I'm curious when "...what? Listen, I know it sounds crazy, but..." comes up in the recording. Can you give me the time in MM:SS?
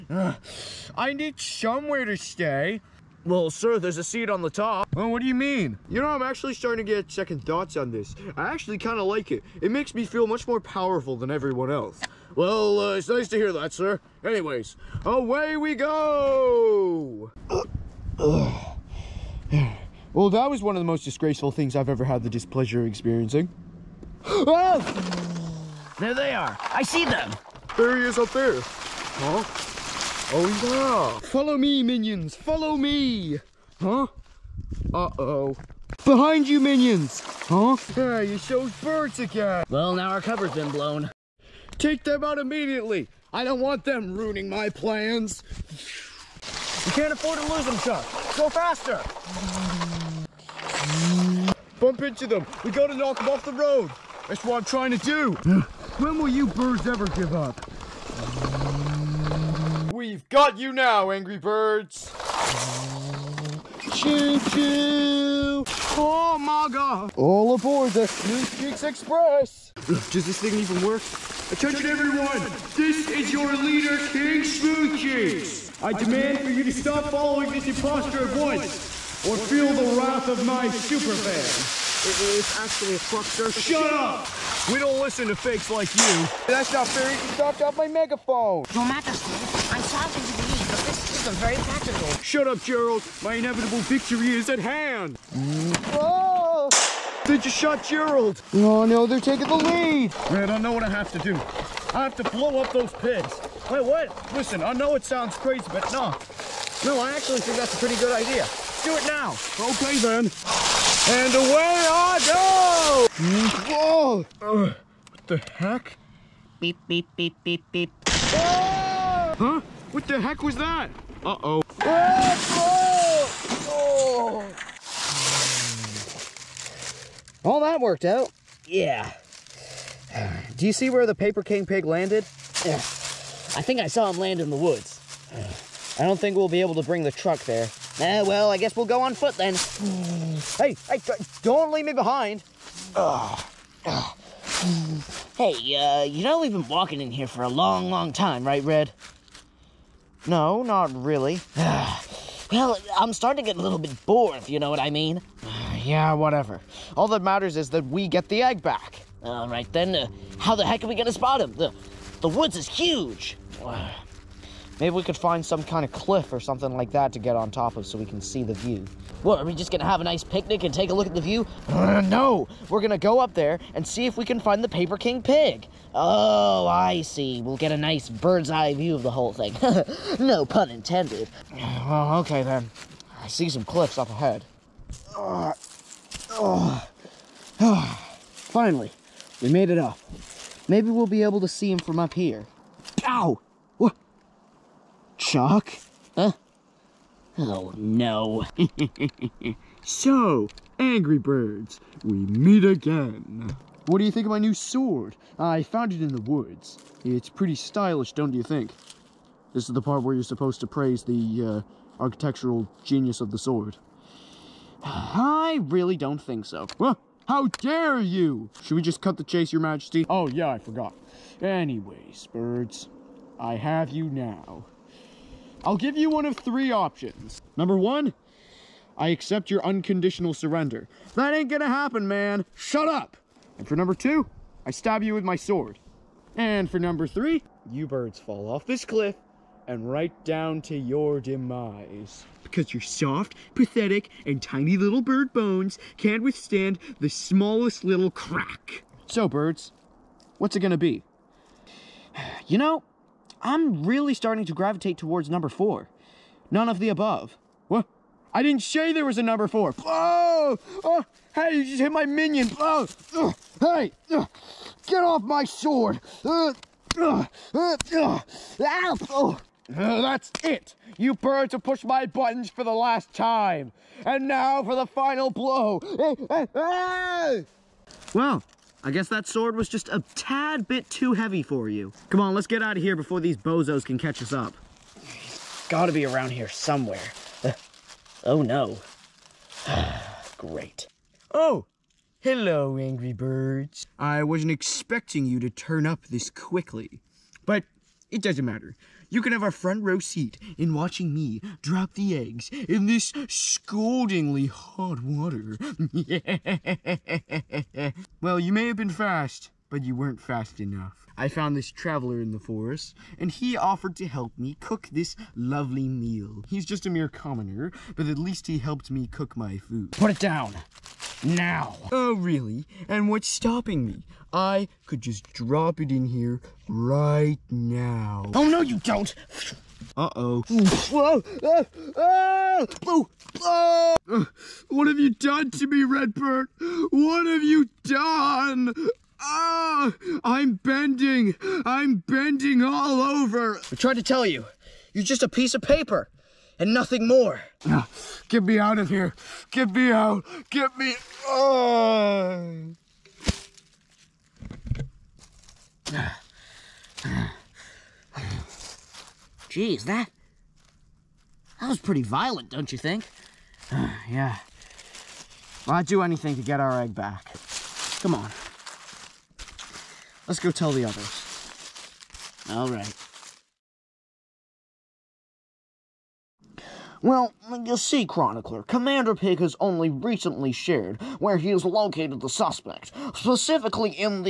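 01:43.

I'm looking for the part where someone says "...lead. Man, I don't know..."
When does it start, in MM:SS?
01:39.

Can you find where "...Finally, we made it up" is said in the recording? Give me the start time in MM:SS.
03:08.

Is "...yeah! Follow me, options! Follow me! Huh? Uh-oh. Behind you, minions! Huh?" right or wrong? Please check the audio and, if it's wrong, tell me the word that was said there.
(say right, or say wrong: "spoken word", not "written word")
wrong: "minions", not "options".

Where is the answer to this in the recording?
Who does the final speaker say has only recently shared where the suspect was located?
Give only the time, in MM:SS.
06:18.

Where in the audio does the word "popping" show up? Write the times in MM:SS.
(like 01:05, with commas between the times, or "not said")
not said.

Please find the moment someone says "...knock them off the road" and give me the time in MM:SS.
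00:52.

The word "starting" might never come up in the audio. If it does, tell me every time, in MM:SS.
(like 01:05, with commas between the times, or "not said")
00:06, 02:33, 04:14.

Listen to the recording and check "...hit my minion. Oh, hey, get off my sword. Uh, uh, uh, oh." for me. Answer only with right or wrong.
right.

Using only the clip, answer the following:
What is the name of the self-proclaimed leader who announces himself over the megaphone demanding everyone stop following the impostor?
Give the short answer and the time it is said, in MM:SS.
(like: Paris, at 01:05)
King Smooth, at 01:14.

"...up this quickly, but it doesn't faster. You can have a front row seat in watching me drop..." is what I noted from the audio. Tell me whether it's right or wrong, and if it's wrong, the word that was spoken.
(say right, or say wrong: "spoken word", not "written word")
wrong: "matter", not "faster".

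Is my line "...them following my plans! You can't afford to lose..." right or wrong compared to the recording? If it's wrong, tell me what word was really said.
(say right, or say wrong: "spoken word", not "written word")
wrong: "ruining", not "following".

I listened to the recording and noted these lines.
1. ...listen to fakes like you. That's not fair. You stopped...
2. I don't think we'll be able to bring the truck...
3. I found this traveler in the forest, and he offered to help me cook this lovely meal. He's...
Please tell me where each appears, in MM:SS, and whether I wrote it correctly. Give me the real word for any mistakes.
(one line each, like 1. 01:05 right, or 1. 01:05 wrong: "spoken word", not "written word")
1. 01:24 right
2. 02:15 right
3. 05:11 right.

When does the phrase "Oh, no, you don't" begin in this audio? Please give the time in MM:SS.
05:28.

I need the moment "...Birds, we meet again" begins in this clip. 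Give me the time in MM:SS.
03:21.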